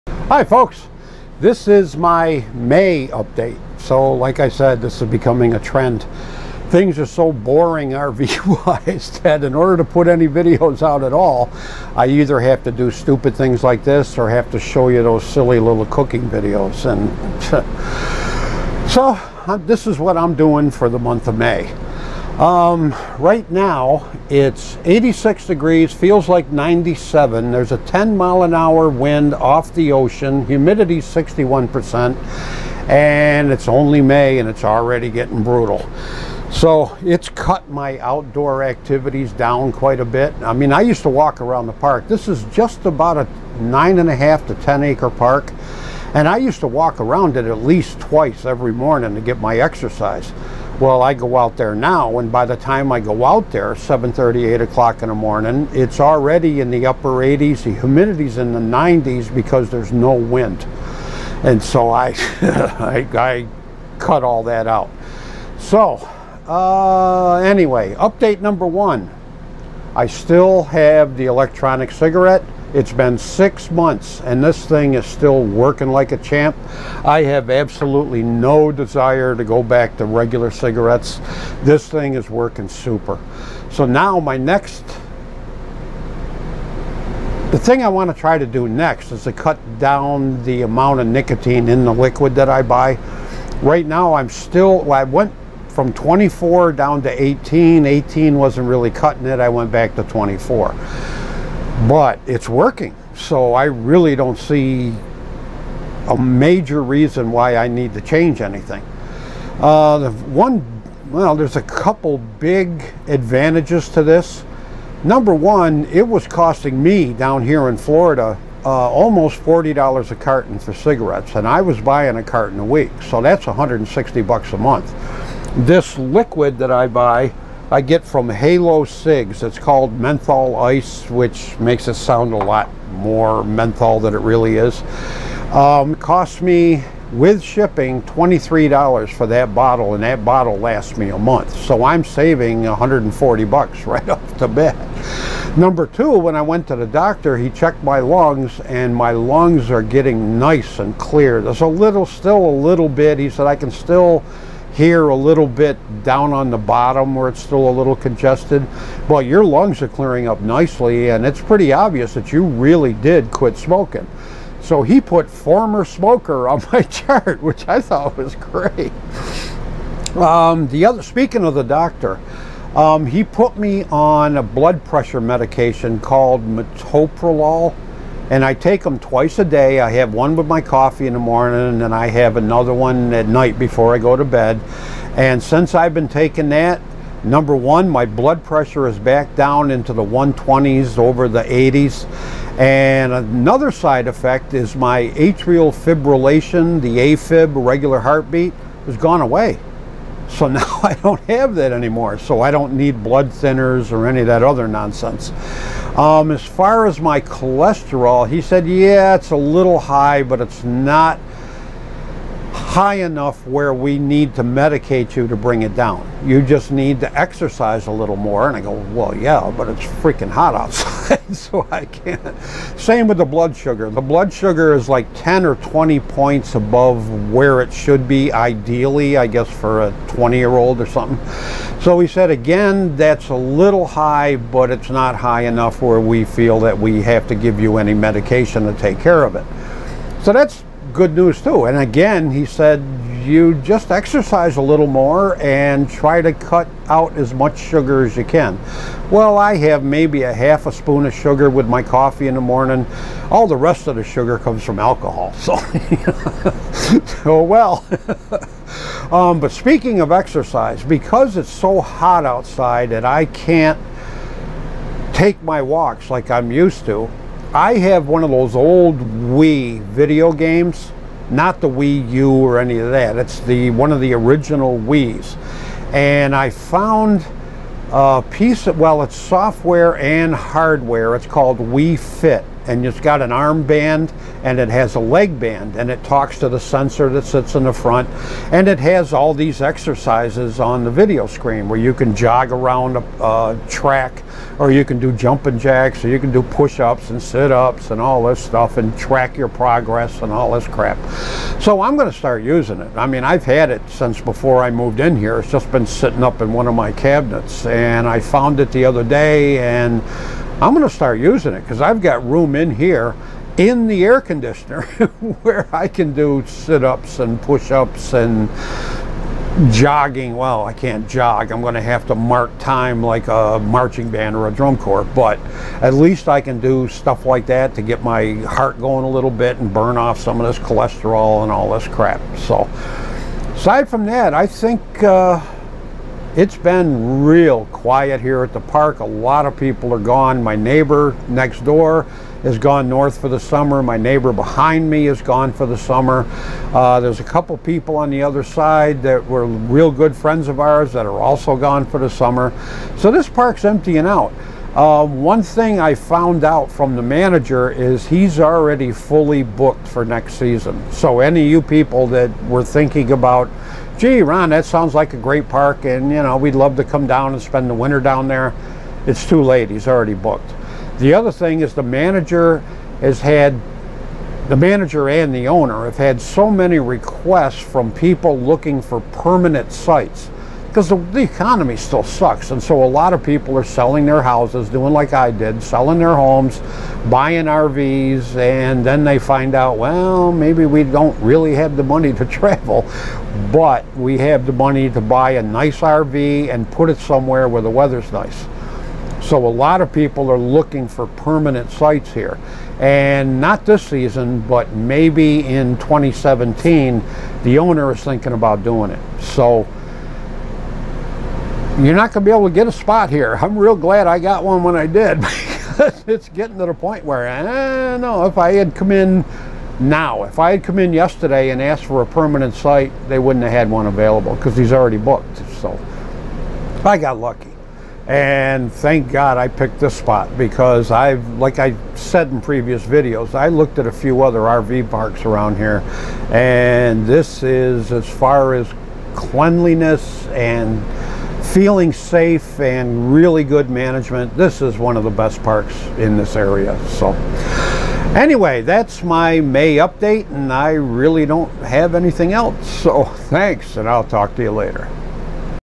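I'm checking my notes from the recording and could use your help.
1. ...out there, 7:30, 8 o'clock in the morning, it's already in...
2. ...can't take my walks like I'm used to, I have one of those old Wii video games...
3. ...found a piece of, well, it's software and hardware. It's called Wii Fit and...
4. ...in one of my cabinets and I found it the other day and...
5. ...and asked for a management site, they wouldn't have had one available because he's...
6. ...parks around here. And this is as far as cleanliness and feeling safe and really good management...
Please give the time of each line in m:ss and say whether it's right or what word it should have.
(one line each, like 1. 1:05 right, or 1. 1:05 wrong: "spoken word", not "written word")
1. 0:53 right
2. 4:23 right
3. 4:36 right
4. 5:06 right
5. 7:01 wrong: "permanent", not "management"
6. 7:14 right.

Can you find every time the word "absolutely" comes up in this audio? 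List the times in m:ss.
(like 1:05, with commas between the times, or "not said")
1:17.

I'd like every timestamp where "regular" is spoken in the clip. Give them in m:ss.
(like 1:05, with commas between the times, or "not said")
1:20, 3:17.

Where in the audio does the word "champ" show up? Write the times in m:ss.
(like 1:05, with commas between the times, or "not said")
1:16.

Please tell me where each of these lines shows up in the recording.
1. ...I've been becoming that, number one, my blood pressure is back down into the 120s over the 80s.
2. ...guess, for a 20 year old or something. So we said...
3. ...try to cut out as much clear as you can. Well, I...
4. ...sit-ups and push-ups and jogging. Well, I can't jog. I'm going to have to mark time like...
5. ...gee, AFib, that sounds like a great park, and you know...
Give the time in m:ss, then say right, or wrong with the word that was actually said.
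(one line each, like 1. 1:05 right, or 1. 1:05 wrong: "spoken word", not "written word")
1. 3:05 wrong: "taking", not "becoming"
2. 3:49 right
3. 4:05 wrong: "sugar", not "clear"
4. 5:16 right
5. 6:03 wrong: "Ron", not "AFib".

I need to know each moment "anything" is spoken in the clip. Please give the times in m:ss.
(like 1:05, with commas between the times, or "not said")
1:48, 7:31.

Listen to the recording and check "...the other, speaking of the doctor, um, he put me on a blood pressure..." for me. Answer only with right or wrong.
right.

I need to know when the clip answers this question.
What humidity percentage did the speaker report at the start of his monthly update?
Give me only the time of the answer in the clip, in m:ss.
0:30.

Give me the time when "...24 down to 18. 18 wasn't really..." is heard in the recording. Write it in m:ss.
1:35.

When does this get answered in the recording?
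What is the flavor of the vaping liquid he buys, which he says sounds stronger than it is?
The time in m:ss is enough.
2:09.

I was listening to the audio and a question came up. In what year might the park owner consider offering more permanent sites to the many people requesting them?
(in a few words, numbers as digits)
2017.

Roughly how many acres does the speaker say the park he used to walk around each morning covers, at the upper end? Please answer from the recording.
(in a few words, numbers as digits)
10 acres.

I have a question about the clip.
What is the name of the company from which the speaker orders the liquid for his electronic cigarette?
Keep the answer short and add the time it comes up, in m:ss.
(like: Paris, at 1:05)
Halo Cigs, at 2:08.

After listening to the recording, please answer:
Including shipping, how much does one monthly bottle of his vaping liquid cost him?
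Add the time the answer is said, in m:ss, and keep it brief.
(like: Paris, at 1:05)
$23, at 2:18.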